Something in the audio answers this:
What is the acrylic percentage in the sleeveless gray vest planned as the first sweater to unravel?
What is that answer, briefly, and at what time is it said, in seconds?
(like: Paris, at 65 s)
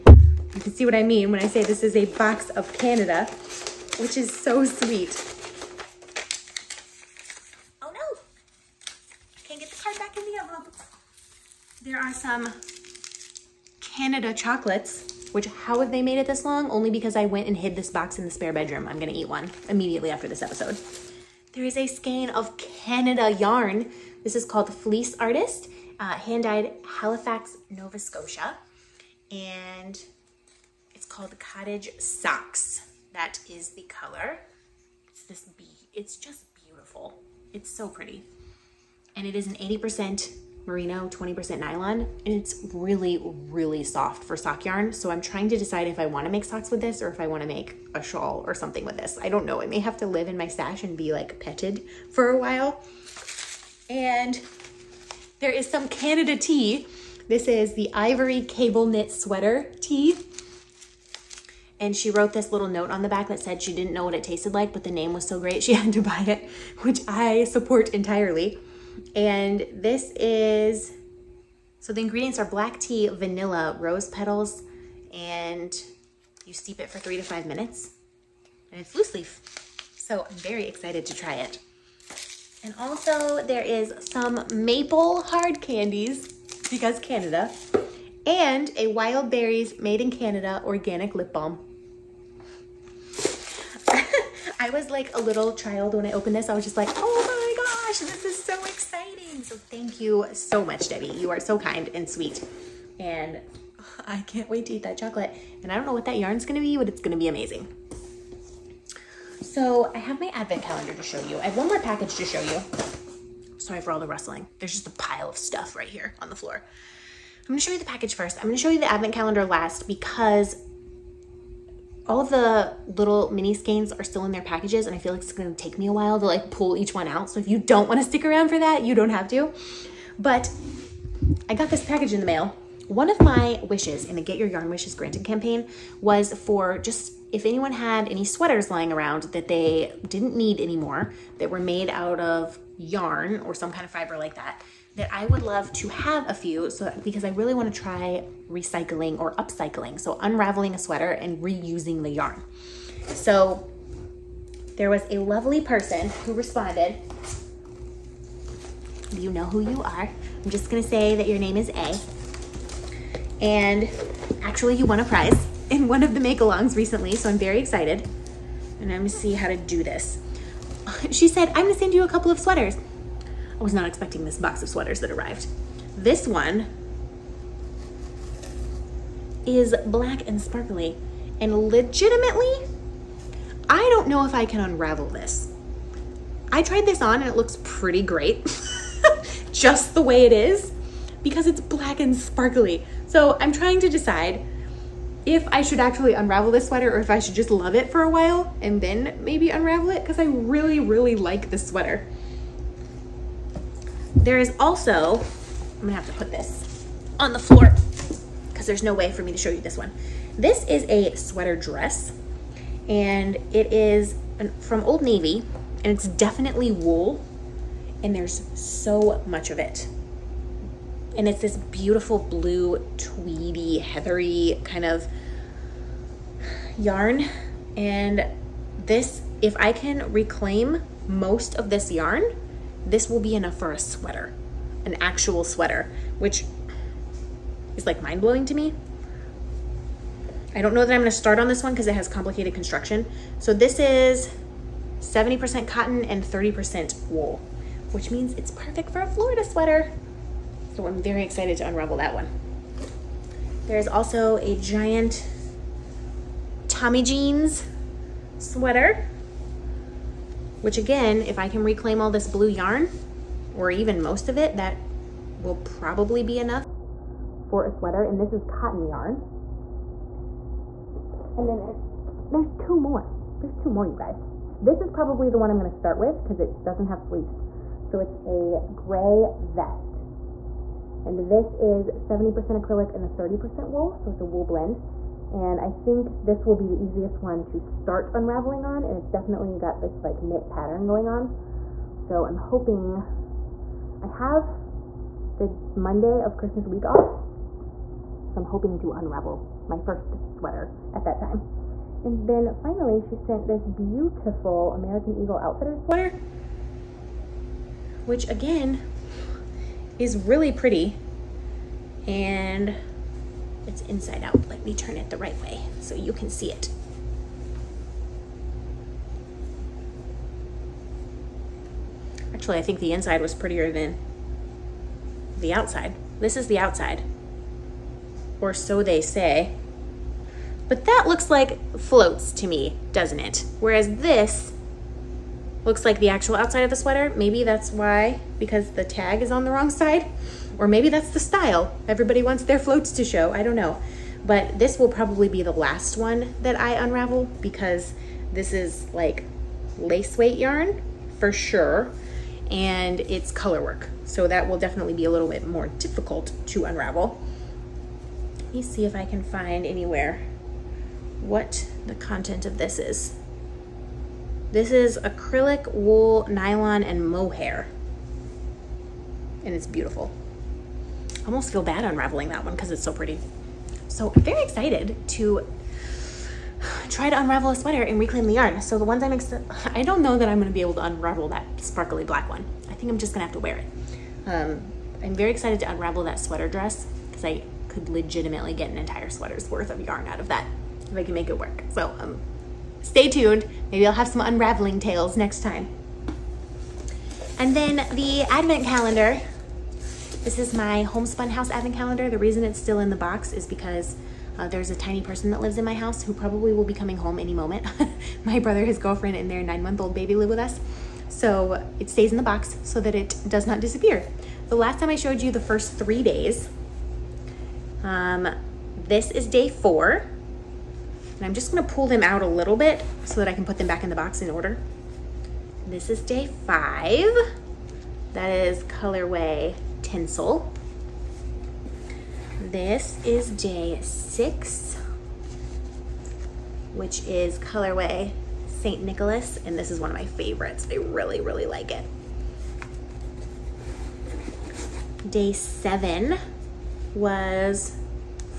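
70%, at 281 s.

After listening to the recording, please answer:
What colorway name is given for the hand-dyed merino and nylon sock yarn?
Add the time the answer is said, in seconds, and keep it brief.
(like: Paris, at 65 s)
Cottage Socks, at 31 s.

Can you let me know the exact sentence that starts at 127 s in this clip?
So if you don't wanna stick around for that, you don't have to.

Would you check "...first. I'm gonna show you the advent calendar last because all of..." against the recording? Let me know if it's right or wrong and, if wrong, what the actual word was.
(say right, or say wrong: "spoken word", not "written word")
right.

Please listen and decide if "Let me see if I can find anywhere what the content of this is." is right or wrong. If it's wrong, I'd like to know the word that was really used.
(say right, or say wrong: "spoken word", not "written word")
right.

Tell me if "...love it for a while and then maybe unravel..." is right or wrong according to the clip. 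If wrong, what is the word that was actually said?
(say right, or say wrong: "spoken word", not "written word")
right.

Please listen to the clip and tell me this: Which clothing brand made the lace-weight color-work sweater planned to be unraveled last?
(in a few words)
American Eagle Outfitter.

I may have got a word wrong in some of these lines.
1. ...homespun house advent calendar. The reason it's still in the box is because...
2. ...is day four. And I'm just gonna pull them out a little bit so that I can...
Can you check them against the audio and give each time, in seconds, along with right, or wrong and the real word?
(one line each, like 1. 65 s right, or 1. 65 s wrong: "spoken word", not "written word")
1. 400 s right
2. 419 s right.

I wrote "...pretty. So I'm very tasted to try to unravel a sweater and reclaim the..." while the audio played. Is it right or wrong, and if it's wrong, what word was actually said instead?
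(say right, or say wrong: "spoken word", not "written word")
wrong: "excited", not "tasted".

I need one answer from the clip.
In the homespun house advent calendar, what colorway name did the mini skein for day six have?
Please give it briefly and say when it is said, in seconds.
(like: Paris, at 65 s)
St. Nicholas, at 438 s.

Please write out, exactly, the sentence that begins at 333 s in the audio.
Whereas this looks like the actual outside of the sweater.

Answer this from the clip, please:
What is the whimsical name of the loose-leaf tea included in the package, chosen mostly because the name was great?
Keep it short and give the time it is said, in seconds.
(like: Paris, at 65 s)
Ivory Cable Knit Sweater Tea, at 57 s.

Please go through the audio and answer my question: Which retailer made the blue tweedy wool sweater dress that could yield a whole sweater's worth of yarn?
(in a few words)
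Old Navy.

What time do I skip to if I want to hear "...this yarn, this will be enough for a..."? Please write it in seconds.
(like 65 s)
231 s.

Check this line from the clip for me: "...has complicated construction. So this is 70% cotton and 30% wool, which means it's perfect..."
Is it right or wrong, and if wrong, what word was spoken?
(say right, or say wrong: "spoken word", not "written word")
right.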